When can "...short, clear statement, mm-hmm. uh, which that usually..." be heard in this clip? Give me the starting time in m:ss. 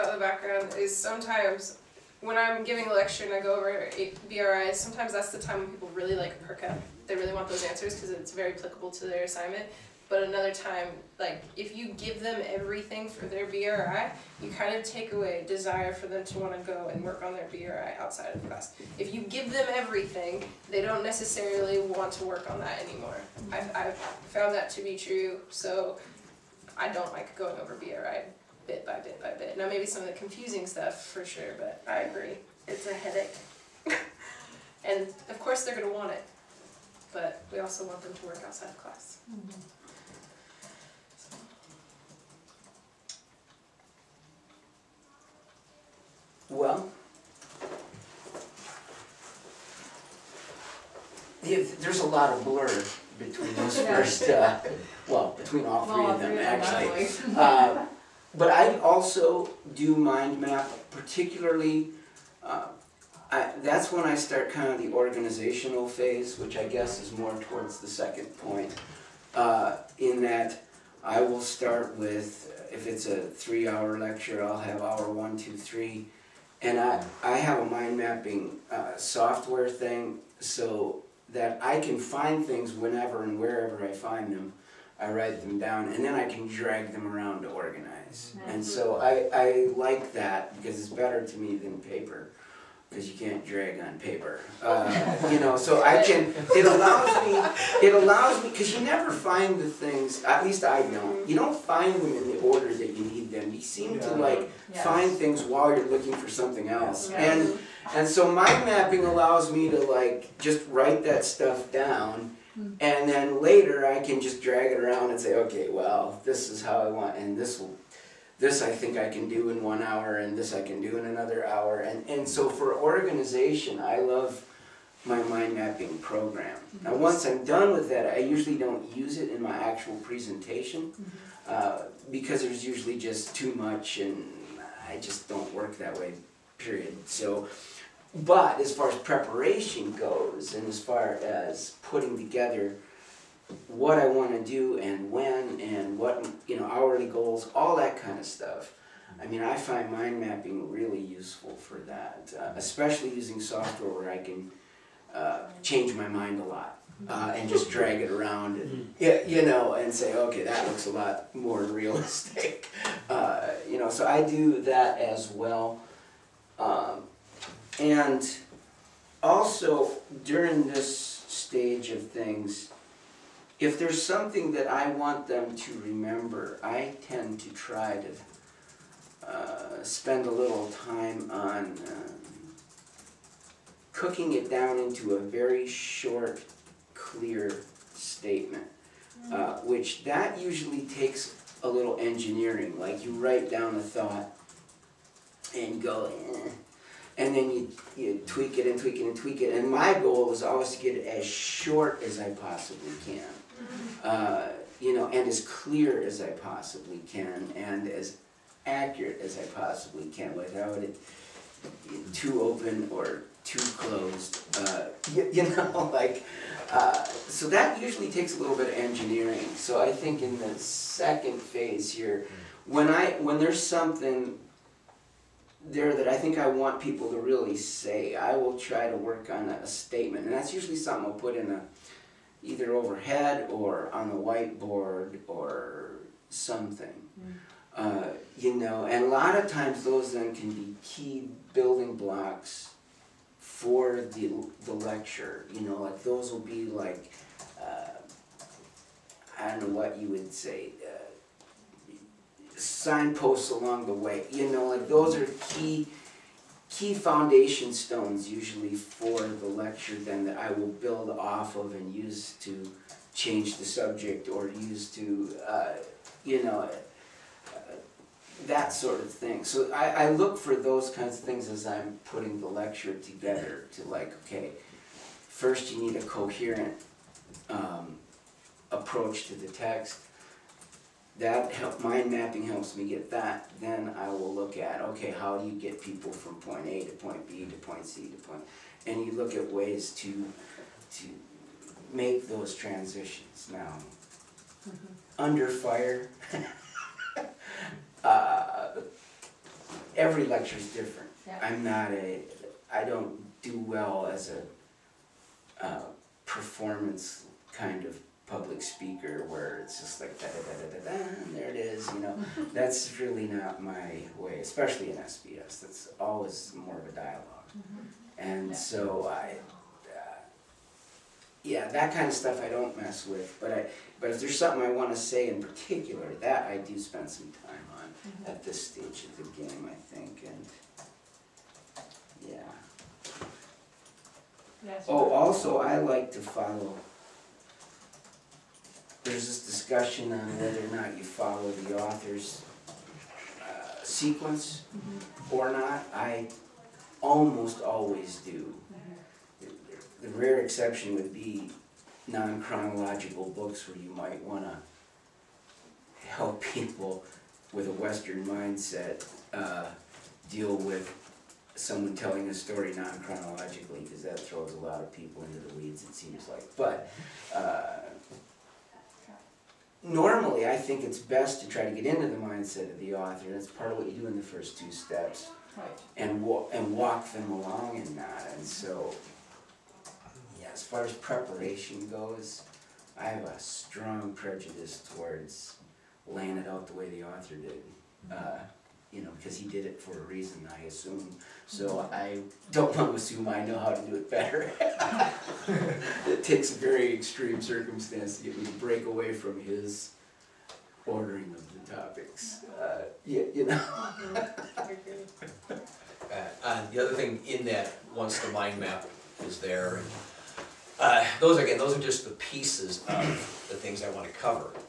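3:05.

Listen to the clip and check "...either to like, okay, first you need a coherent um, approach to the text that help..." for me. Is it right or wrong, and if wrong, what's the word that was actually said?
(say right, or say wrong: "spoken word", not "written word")
wrong: "together", not "either".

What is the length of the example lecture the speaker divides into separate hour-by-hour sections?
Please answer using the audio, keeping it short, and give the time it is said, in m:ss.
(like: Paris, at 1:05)
3 hours, at 1:13.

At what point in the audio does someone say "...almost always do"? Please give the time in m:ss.
5:47.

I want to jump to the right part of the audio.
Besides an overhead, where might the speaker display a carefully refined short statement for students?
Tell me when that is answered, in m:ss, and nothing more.
3:54.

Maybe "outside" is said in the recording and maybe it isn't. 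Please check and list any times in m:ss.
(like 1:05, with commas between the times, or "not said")
0:18, 0:38.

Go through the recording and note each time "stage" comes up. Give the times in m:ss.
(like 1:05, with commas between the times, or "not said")
2:51, 5:28.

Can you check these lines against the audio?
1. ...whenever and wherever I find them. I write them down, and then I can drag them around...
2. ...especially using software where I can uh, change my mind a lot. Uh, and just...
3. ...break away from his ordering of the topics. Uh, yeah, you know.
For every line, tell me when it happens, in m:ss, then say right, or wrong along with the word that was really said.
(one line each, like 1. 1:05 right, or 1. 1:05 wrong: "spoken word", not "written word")
1. 1:22 right
2. 2:32 right
3. 6:38 right.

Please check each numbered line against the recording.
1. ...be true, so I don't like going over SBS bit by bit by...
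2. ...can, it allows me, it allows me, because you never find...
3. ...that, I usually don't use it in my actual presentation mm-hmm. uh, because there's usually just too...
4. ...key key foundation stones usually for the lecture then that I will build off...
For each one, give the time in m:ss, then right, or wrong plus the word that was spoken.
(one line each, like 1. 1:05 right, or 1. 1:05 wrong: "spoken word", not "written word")
1. 0:24 wrong: "BRI", not "SBS"
2. 1:36 right
3. 2:07 right
4. 4:15 right.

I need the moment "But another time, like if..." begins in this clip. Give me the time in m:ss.
0:10.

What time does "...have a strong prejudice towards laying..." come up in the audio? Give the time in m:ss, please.
6:23.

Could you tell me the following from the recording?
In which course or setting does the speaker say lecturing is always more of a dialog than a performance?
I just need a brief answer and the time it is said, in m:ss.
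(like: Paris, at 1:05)
SBS, at 5:14.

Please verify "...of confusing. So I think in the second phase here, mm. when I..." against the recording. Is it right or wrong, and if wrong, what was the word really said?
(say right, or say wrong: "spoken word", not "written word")
wrong: "engineering", not "confusing".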